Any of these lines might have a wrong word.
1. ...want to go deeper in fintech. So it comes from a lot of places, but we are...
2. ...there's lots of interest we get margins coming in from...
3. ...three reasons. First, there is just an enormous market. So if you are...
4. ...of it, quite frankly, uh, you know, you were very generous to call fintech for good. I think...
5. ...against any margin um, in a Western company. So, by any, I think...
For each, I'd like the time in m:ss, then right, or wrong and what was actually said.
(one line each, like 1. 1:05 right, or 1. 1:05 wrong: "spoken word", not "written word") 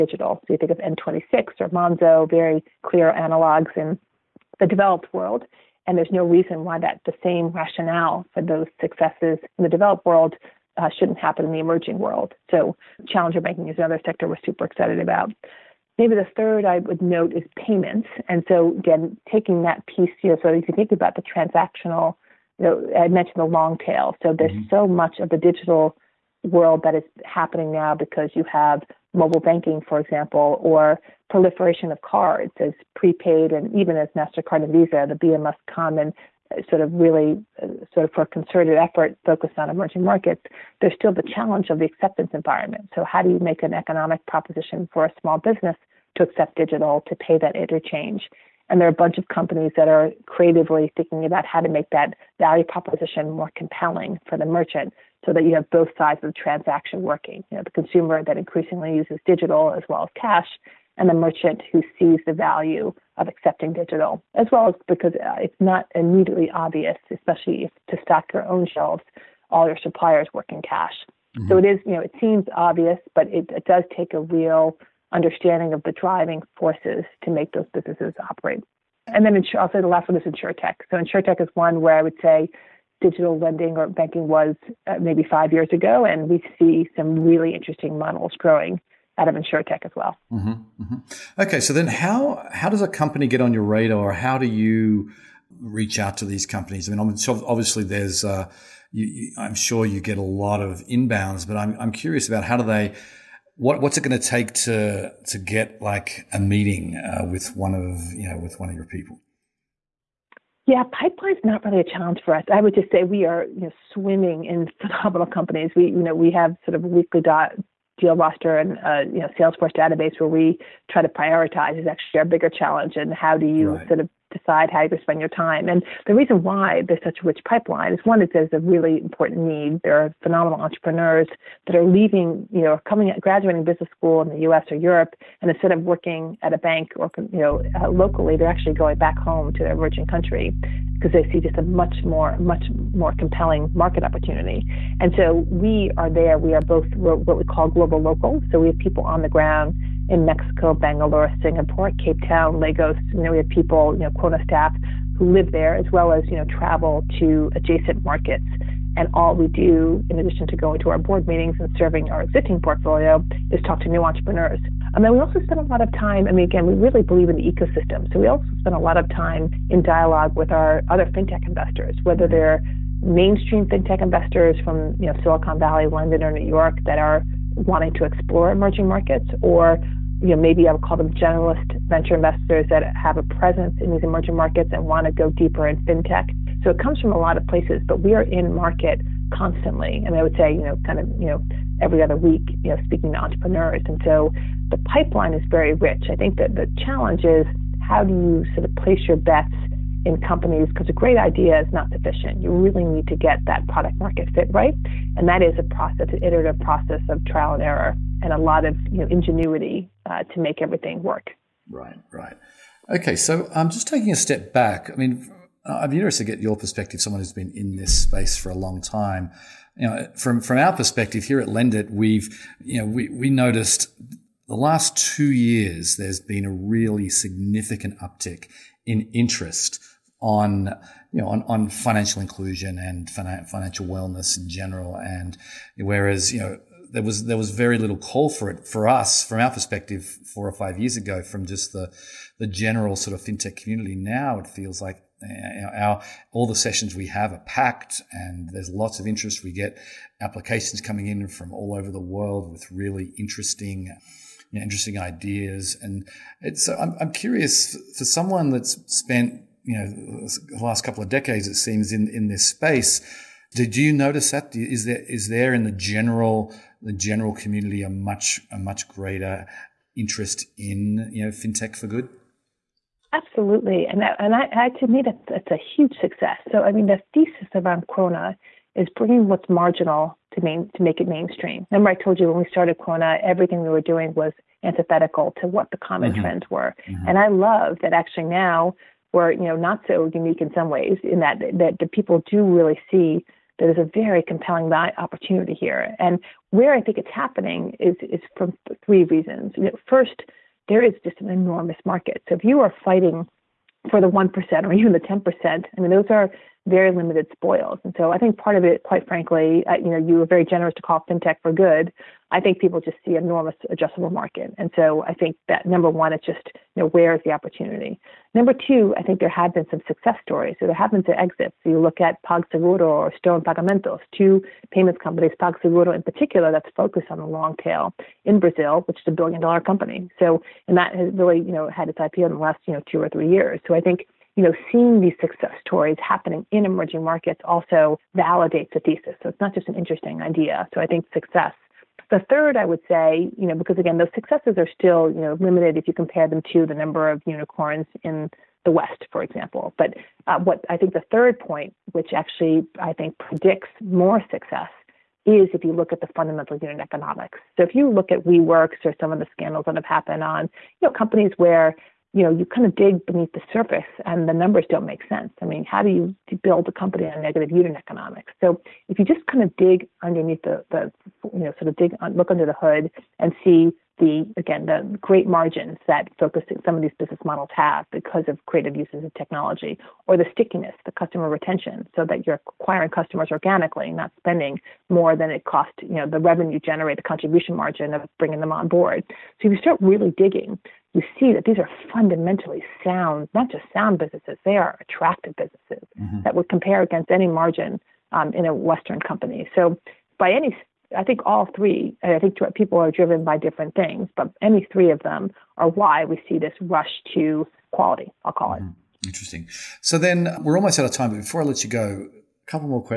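1. 3:04 right
2. 4:08 wrong: "applications", not "margins"
3. 4:58 right
4. 5:08 right
5. 6:36 right.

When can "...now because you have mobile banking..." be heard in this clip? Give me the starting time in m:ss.
0:27.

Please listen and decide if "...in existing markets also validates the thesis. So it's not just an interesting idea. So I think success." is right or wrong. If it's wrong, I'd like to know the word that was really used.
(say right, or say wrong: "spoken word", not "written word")
wrong: "emerging", not "existing".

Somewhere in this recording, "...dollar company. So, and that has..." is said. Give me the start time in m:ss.
5:29.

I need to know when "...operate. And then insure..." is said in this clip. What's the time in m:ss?
1:18.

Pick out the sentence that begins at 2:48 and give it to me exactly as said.
So we also spend a lot of time in dialogue with our other fintech investors, whether mm-hmm.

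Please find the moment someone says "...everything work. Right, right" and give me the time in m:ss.
3:30.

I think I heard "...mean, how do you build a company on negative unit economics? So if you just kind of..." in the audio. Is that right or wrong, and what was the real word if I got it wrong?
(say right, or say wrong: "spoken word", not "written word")
right.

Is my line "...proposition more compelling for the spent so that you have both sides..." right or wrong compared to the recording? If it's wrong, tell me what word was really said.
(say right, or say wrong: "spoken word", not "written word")
wrong: "merchant", not "spent".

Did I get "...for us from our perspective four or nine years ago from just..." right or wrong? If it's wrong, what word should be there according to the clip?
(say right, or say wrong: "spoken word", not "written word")
wrong: "five", not "nine".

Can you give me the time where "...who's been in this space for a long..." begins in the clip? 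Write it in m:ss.
3:37.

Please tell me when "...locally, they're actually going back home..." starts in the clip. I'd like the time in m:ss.
2:17.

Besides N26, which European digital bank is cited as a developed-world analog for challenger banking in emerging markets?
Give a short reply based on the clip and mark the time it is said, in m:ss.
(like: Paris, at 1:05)
Monzo, at 0:01.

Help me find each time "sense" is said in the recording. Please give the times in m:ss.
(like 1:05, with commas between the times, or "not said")
6:05.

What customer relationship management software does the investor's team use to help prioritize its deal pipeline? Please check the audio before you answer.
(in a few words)
Salesforce.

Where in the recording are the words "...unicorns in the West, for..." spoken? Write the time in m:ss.
5:47.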